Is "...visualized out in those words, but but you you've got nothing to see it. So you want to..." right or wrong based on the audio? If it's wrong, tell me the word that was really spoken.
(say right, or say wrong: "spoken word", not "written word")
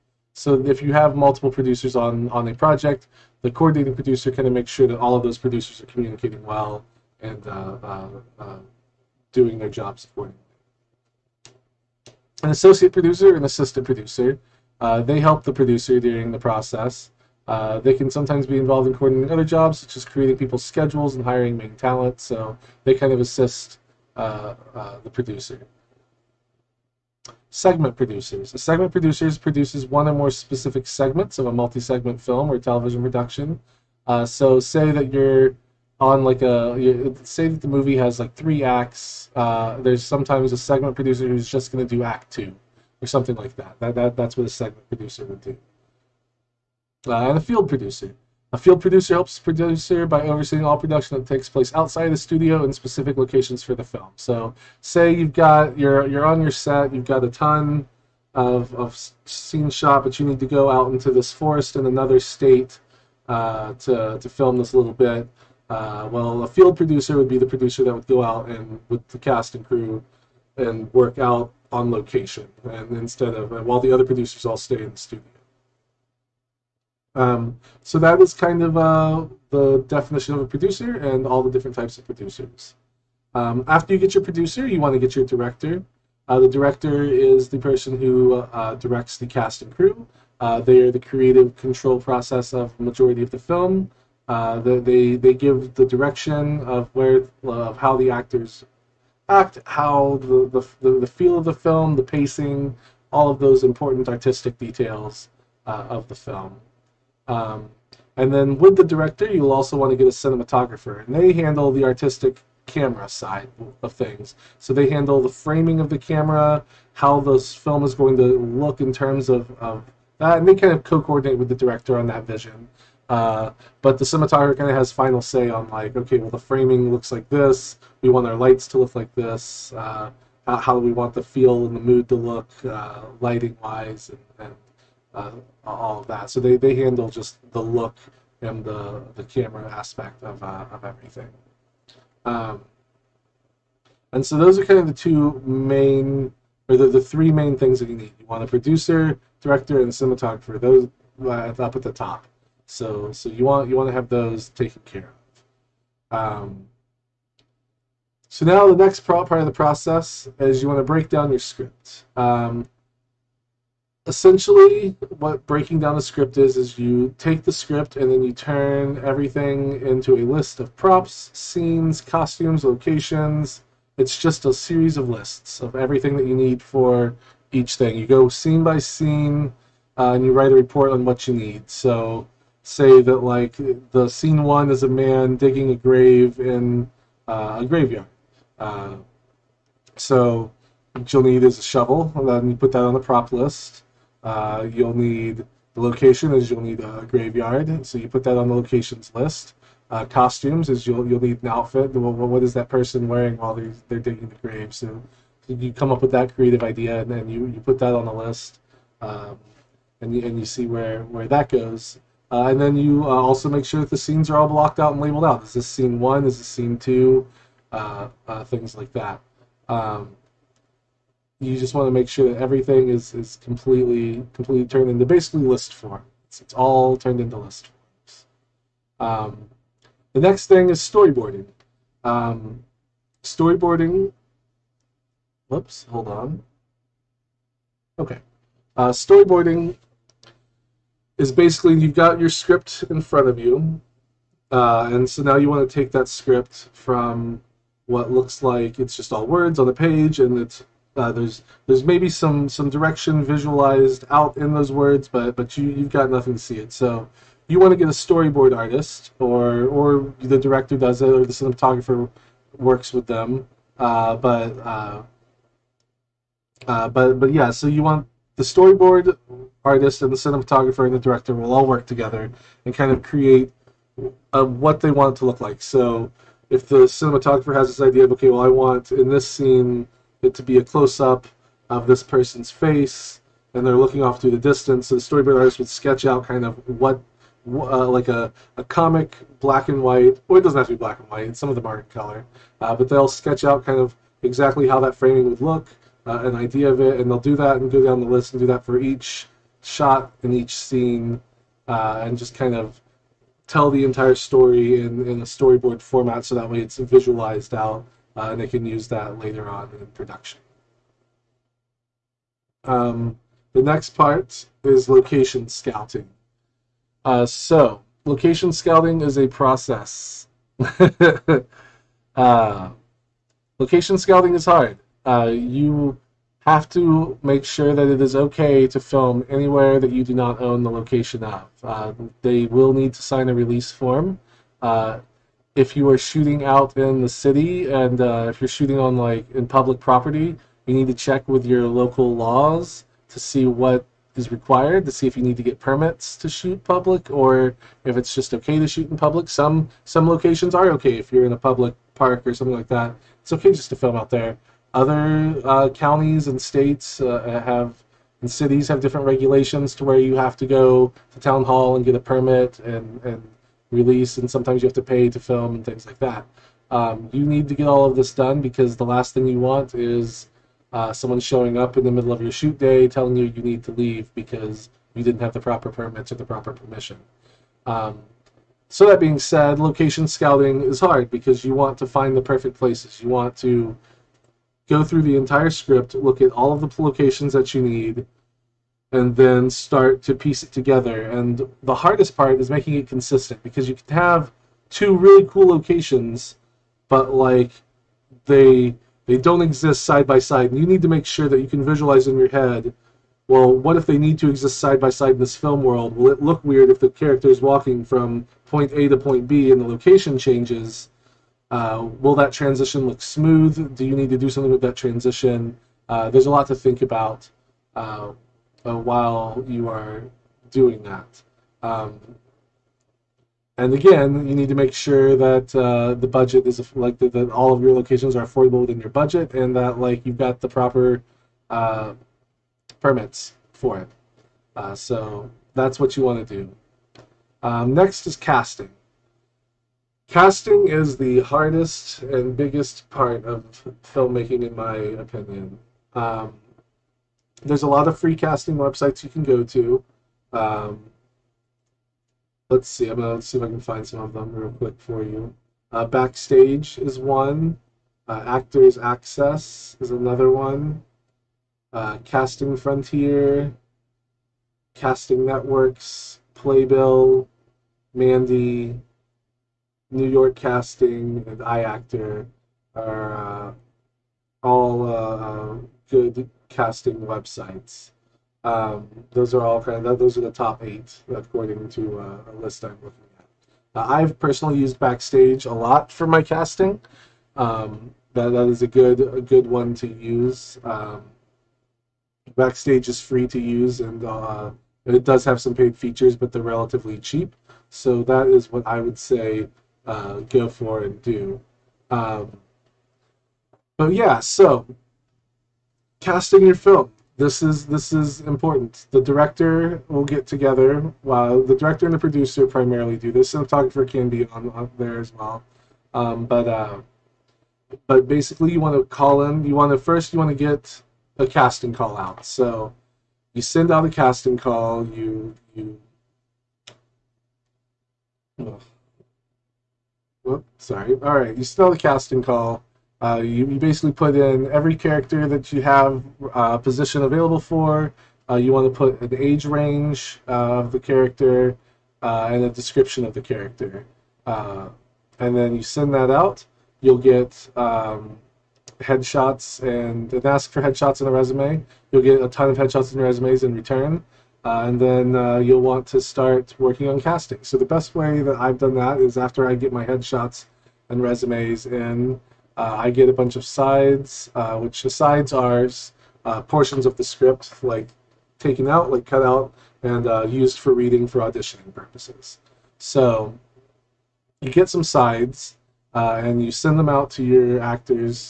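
right.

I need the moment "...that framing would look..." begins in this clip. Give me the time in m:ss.
4:54.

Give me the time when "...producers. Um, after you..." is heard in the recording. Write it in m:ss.
1:22.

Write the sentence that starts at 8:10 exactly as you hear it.
Um, Backstage is free to use and uh, it does have some paid features, but they're relatively cheap.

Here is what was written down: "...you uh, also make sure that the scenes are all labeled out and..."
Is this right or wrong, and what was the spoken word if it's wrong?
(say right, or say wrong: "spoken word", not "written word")
wrong: "blocked", not "labeled".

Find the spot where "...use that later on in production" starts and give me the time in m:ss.
5:08.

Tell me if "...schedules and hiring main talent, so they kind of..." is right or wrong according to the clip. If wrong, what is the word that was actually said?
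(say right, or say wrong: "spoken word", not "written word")
right.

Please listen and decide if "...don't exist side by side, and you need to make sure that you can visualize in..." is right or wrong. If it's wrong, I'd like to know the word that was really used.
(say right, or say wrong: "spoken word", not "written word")
right.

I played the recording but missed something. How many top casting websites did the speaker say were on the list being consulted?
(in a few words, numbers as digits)
8.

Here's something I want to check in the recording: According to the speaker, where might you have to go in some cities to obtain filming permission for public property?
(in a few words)
Town hall.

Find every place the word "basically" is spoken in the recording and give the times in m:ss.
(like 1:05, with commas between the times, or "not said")
3:45, 4:01, 8:38, 8:53.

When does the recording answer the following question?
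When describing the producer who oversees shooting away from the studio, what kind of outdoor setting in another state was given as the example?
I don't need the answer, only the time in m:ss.
1:01.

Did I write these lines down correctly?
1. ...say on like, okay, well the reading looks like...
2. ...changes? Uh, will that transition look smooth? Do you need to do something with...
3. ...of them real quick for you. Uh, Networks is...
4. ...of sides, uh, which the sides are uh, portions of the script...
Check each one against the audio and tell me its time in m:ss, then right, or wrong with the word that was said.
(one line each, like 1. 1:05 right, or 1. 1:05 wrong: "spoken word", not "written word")
1. 2:05 wrong: "framing", not "reading"
2. 6:50 right
3. 7:33 wrong: "Backstage", not "Networks"
4. 9:23 right.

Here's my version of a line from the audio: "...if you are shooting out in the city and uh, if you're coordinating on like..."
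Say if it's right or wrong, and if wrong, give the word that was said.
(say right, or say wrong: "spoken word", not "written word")
wrong: "shooting", not "coordinating".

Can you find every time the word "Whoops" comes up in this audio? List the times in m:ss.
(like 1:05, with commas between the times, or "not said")
3:55, 8:50.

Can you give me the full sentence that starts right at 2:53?
It's just a series of lists of everything that you need for each thing.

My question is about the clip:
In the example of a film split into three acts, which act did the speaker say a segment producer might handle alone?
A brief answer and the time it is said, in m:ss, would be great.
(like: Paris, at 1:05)
Act two, at 0:42.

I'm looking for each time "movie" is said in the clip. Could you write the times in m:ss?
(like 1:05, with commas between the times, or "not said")
0:37.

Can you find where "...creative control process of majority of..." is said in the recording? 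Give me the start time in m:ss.
1:30.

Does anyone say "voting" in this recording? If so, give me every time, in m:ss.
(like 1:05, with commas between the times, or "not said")
not said.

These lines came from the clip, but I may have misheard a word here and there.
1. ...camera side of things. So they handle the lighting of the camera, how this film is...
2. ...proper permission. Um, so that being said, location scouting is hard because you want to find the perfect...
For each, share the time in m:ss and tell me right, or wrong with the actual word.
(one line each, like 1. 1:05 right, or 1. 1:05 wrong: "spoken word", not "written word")
1. 1:52 wrong: "framing", not "lighting"
2. 6:16 right.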